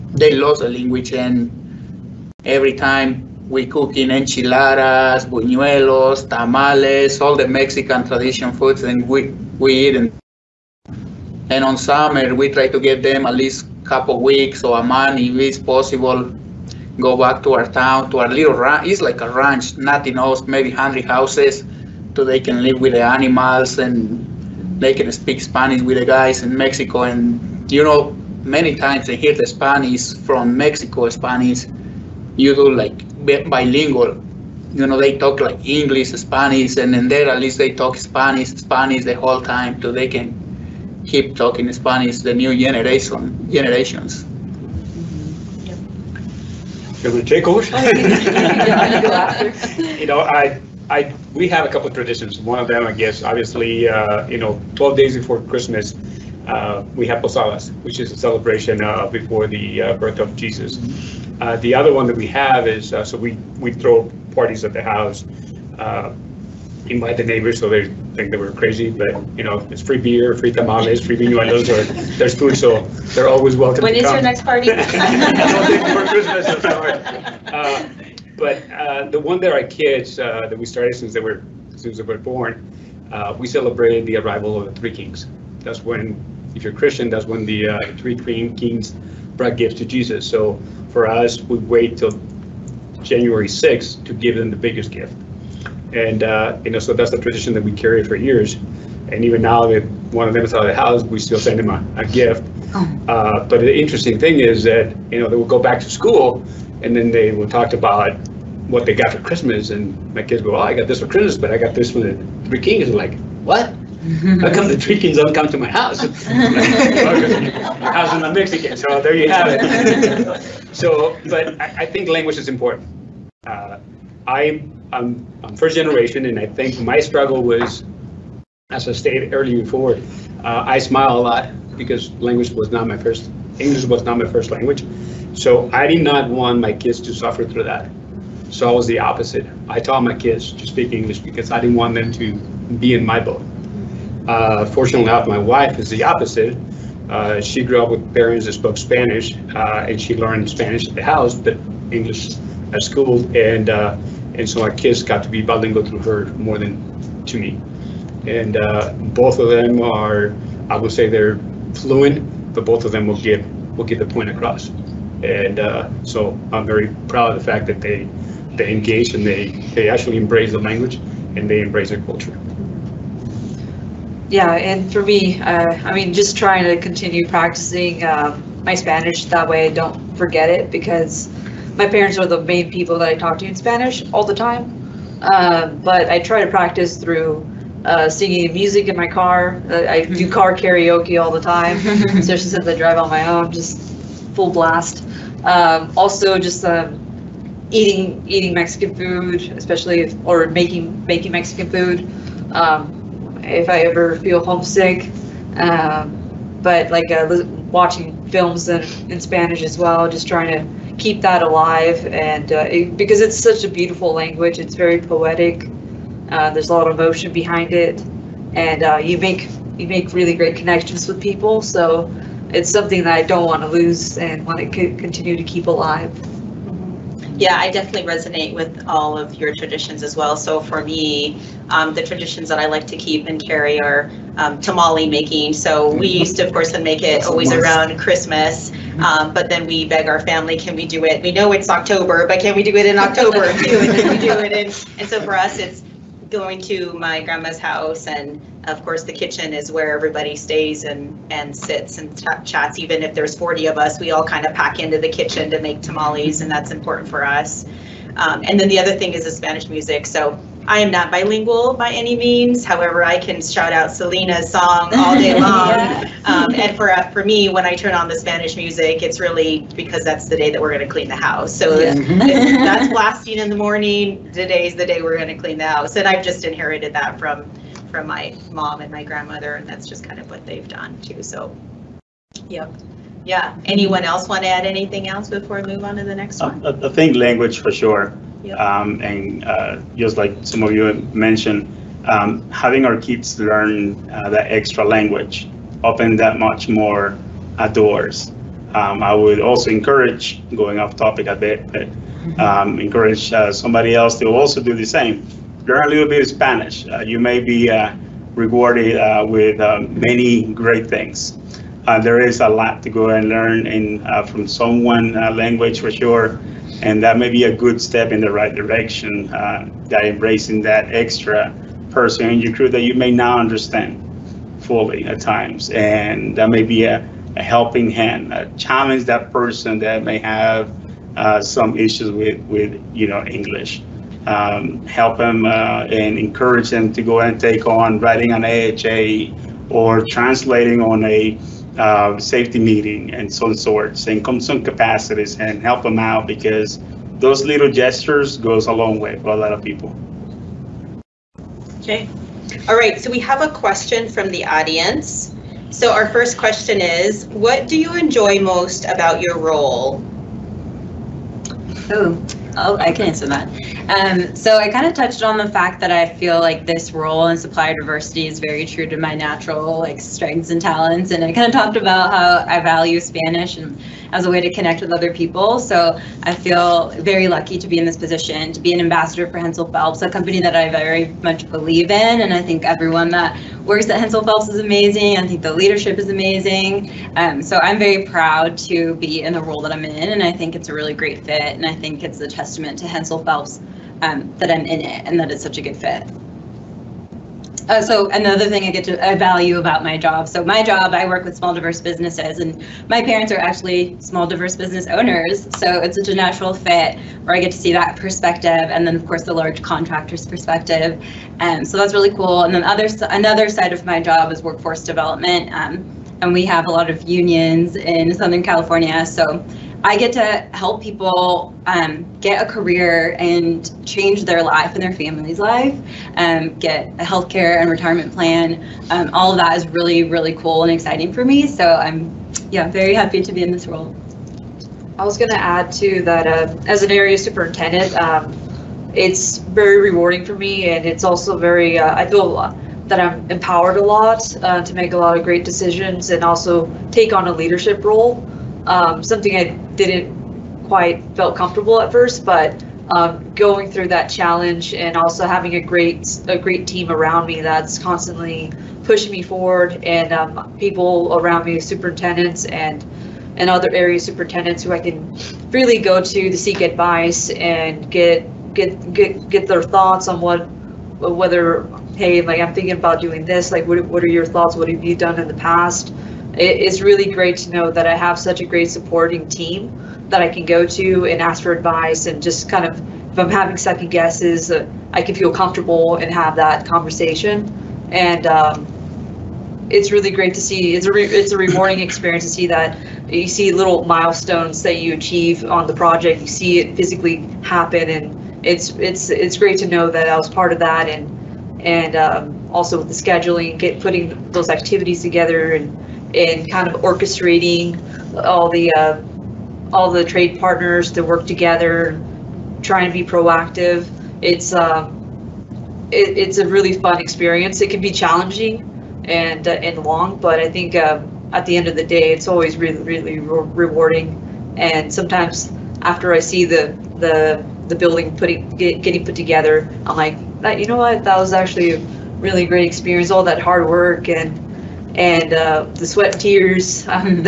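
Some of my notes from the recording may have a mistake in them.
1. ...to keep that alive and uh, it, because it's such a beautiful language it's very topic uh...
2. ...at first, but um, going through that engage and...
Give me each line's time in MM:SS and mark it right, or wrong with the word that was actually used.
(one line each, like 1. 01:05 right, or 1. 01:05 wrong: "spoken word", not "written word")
1. 03:30 wrong: "poetic", not "topic"
2. 07:31 wrong: "challenge", not "engage".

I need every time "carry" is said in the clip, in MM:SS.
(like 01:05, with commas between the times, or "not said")
01:37, 03:53.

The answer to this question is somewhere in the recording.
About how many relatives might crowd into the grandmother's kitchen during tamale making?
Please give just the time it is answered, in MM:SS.
04:13.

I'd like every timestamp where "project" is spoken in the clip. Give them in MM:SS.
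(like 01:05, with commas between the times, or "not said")
08:15.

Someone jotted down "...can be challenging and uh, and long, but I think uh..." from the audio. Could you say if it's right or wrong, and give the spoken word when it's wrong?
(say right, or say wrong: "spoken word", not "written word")
right.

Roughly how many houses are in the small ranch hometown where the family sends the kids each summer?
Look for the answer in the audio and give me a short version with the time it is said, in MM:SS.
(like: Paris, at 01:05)
100, at 00:20.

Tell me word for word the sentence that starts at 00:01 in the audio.
And every time we cook in enchiladas, buñuelos, tamales, all the Mexican tradition foods, and we we eat.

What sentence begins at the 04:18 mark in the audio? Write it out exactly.
Um, and then the other thing is the Spanish music.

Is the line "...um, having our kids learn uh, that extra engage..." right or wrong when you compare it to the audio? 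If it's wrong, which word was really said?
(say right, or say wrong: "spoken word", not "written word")
wrong: "language", not "engage".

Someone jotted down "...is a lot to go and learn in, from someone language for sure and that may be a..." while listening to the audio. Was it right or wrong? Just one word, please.
right.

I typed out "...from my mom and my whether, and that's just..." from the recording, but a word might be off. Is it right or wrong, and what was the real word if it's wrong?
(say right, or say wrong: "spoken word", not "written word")
wrong: "grandmother", not "whether".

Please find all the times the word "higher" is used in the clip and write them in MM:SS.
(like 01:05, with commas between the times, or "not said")
not said.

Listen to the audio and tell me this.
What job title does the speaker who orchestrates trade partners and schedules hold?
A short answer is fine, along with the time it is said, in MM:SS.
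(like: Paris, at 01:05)
Area superintendent, at 07:16.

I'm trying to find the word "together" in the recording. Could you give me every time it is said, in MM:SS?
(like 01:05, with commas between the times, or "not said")
08:25, 08:31, 08:49.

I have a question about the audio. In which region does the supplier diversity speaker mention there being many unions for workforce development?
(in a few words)
Southern California.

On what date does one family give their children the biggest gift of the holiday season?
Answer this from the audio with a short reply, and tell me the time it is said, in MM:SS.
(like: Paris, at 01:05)
January 6th, at 01:33.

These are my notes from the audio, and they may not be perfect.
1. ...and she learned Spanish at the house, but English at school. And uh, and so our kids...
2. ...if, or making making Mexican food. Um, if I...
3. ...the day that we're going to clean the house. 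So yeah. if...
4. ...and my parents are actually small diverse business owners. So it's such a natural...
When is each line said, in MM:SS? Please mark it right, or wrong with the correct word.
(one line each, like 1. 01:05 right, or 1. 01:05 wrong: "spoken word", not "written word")
1. 02:29 right
2. 03:20 right
3. 04:30 right
4. 06:42 right.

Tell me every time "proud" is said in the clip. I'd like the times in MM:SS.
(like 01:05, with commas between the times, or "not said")
02:47, 06:28.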